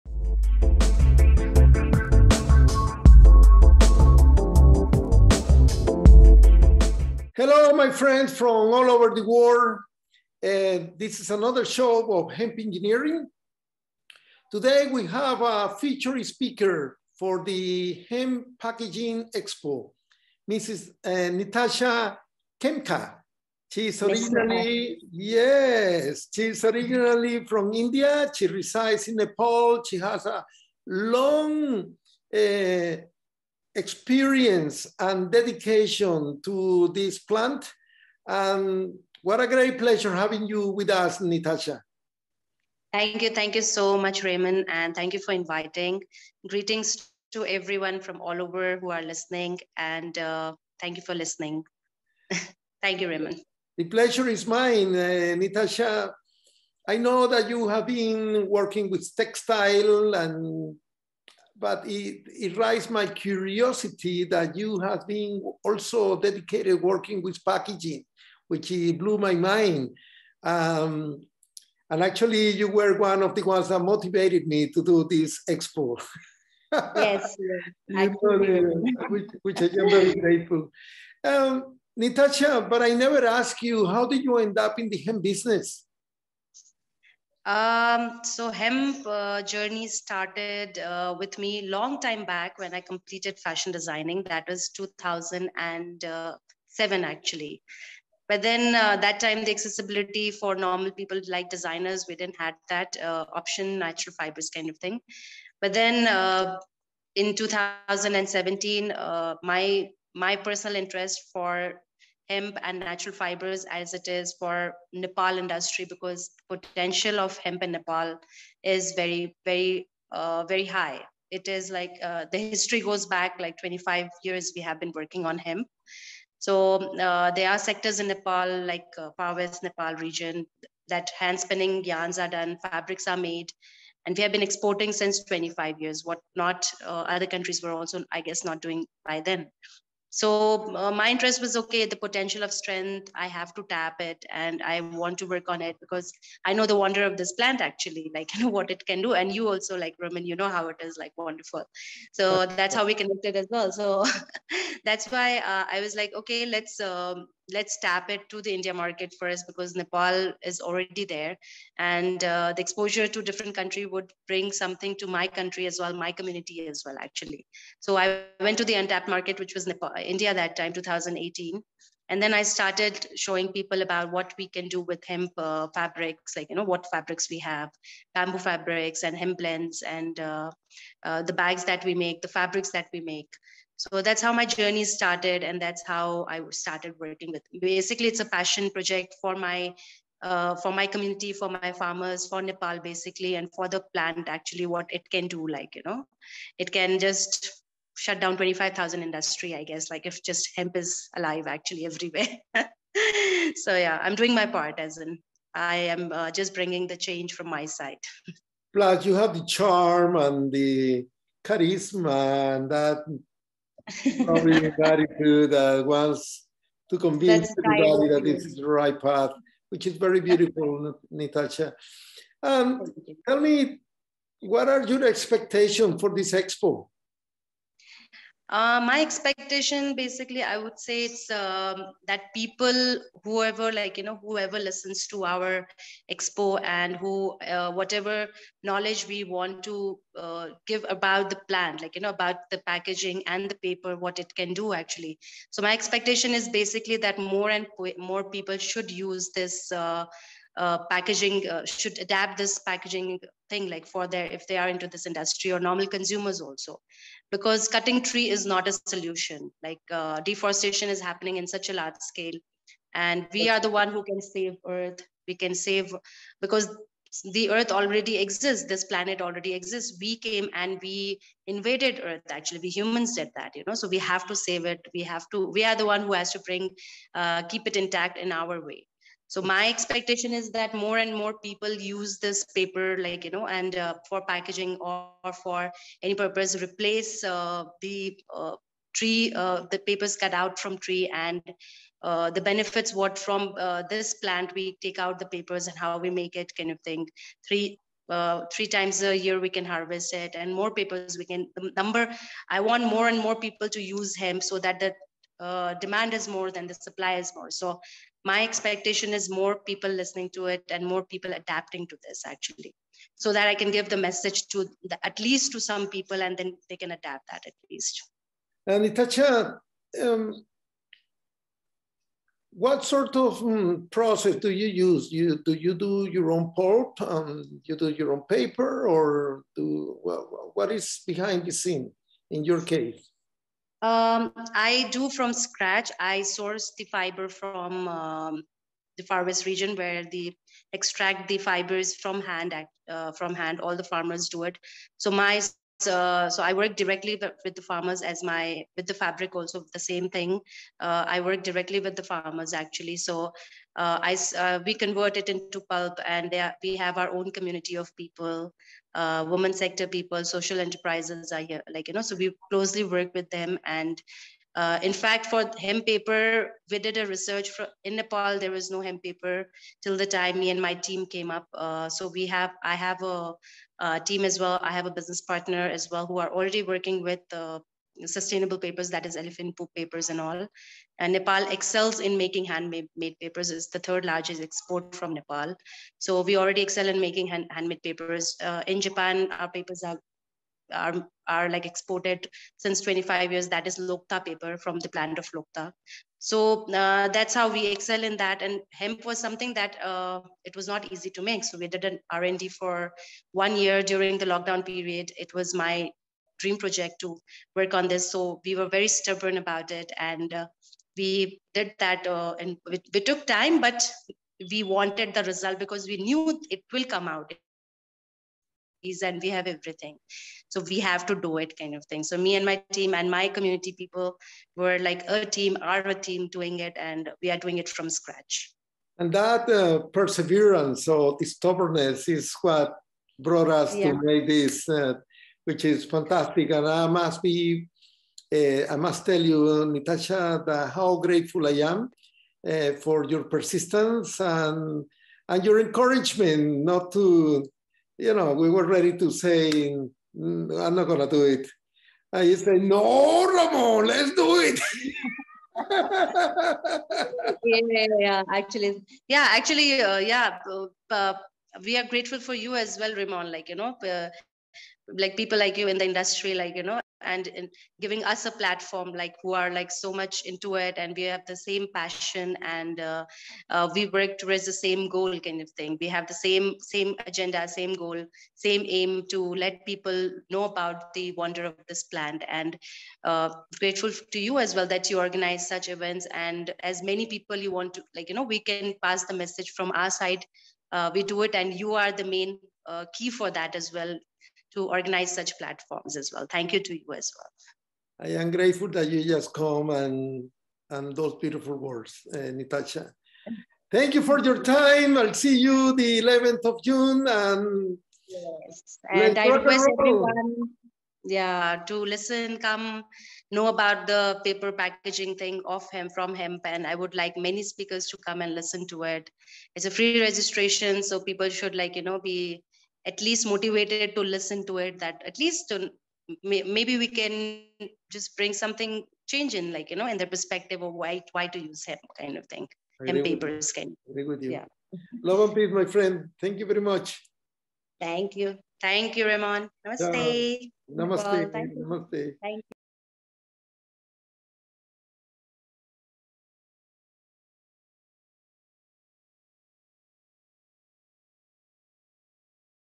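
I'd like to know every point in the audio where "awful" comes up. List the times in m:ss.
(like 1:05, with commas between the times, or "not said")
not said.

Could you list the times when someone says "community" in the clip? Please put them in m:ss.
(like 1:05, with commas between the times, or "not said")
2:46, 3:10, 5:57, 7:03.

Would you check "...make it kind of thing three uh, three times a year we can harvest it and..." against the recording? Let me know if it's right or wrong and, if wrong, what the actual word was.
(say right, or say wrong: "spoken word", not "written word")
right.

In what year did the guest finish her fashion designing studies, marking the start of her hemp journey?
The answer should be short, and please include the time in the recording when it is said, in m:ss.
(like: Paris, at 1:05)
2007, at 1:34.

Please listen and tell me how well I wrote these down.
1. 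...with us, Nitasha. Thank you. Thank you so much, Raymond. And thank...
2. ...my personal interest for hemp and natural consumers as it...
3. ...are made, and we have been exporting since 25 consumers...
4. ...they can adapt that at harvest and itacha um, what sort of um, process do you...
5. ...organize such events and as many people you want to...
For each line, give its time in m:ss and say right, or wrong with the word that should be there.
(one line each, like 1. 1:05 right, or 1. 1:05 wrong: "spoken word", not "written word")
1. 0:40 right
2. 1:50 wrong: "fibers", not "consumers"
3. 2:13 wrong: "years", not "consumers"
4. 5:16 wrong: "least", not "harvest"
5. 8:04 right.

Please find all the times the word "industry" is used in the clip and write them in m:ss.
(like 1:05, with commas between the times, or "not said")
1:55, 3:19, 4:15, 7:45.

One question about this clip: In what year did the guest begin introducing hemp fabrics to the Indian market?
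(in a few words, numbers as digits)
2018.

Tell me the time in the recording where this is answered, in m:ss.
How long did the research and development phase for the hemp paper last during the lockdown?
6:43.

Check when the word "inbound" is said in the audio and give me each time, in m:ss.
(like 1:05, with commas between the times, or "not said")
not said.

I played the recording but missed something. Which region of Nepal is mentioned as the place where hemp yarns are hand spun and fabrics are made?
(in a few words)
Far West Nepal.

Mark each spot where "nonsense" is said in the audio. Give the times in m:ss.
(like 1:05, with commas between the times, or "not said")
not said.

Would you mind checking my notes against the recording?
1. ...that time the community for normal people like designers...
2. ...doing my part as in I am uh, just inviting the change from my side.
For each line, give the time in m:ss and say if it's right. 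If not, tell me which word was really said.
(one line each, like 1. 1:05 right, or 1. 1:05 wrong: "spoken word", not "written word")
1. 1:38 wrong: "accessibility", not "community"
2. 3:24 wrong: "bringing", not "inviting".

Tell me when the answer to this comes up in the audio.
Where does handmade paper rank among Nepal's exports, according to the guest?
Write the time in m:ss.
6:23.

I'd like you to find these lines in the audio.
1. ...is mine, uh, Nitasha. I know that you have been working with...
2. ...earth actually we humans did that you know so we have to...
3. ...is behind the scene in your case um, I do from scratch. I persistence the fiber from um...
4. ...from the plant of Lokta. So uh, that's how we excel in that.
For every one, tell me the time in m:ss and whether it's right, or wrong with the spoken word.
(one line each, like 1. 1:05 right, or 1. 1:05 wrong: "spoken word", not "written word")
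1. 0:54 right
2. 4:32 right
3. 5:30 wrong: "source", not "persistence"
4. 6:34 right.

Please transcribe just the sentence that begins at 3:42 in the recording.
Um, tell me, what are your expectations for this expo?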